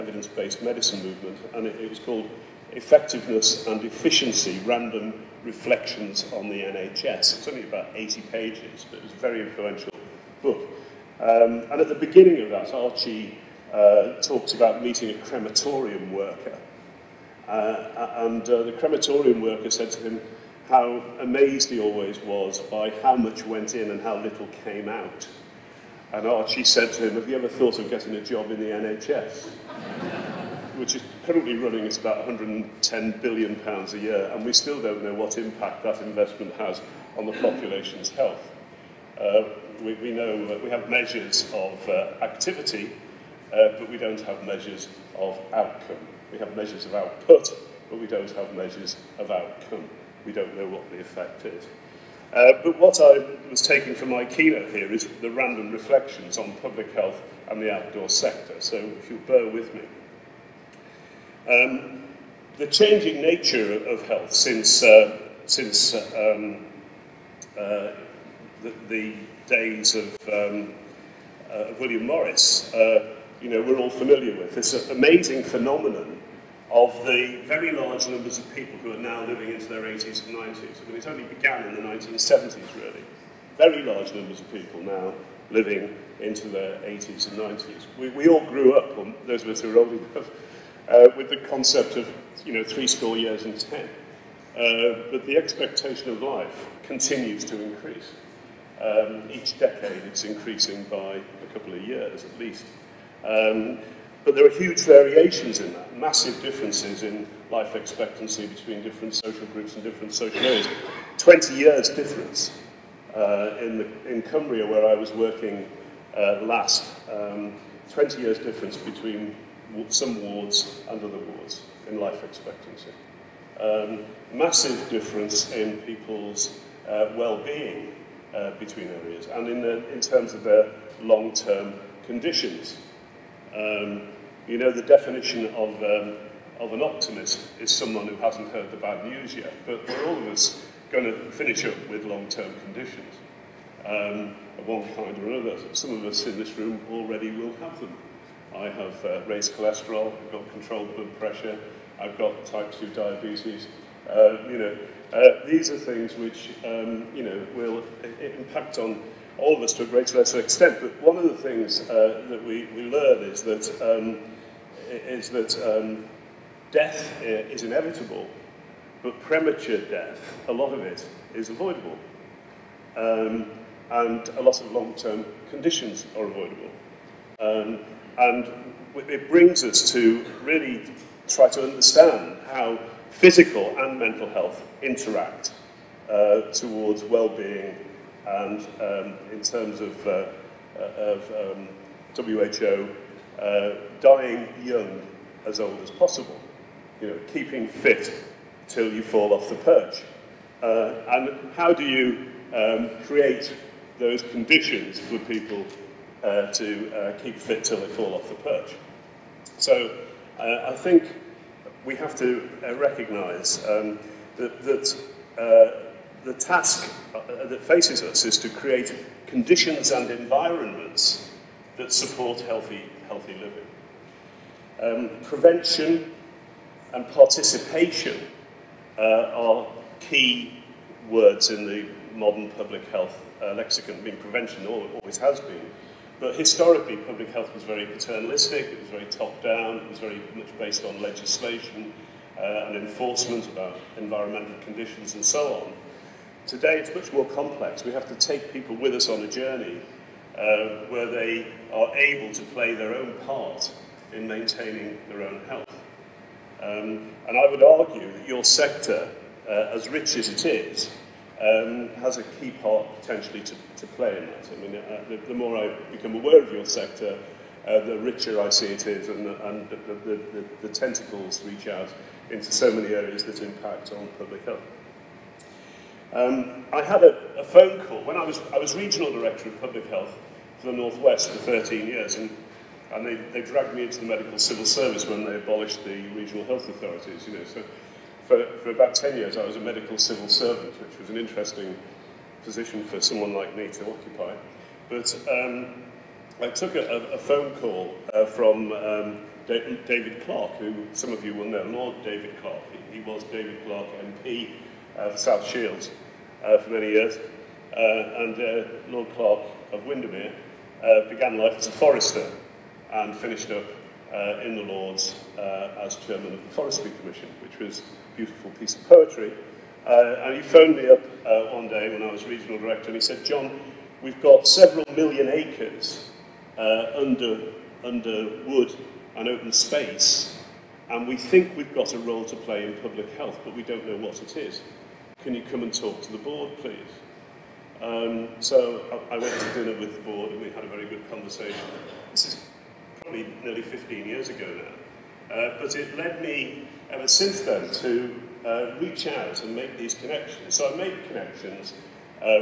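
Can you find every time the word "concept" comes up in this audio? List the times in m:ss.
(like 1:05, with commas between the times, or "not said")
1:31.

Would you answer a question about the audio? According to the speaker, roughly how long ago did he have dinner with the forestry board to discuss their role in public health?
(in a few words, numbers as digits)
15 years.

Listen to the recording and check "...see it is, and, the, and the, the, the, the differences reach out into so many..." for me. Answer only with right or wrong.
wrong.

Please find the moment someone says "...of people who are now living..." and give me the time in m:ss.
1:18.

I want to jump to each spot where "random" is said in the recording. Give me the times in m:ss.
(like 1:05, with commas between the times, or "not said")
0:04, 0:55.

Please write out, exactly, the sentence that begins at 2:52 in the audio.
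Um, and a lot of long-term conditions are avoidable.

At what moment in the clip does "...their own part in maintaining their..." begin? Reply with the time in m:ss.
4:12.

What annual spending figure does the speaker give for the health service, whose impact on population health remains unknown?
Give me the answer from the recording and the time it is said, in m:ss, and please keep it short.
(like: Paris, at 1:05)
110 billion pounds, at 0:32.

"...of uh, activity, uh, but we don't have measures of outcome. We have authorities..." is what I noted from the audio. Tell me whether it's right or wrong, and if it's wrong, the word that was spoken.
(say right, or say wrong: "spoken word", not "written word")
wrong: "measures", not "authorities".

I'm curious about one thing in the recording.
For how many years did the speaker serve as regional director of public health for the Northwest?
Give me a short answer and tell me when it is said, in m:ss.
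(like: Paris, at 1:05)
13, at 4:41.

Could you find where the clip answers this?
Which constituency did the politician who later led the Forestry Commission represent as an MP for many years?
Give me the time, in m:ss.
5:05.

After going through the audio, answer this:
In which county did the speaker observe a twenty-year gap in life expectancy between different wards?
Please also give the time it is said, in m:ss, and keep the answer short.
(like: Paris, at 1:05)
Cumbria, at 1:54.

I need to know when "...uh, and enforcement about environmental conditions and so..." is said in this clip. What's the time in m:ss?
4:02.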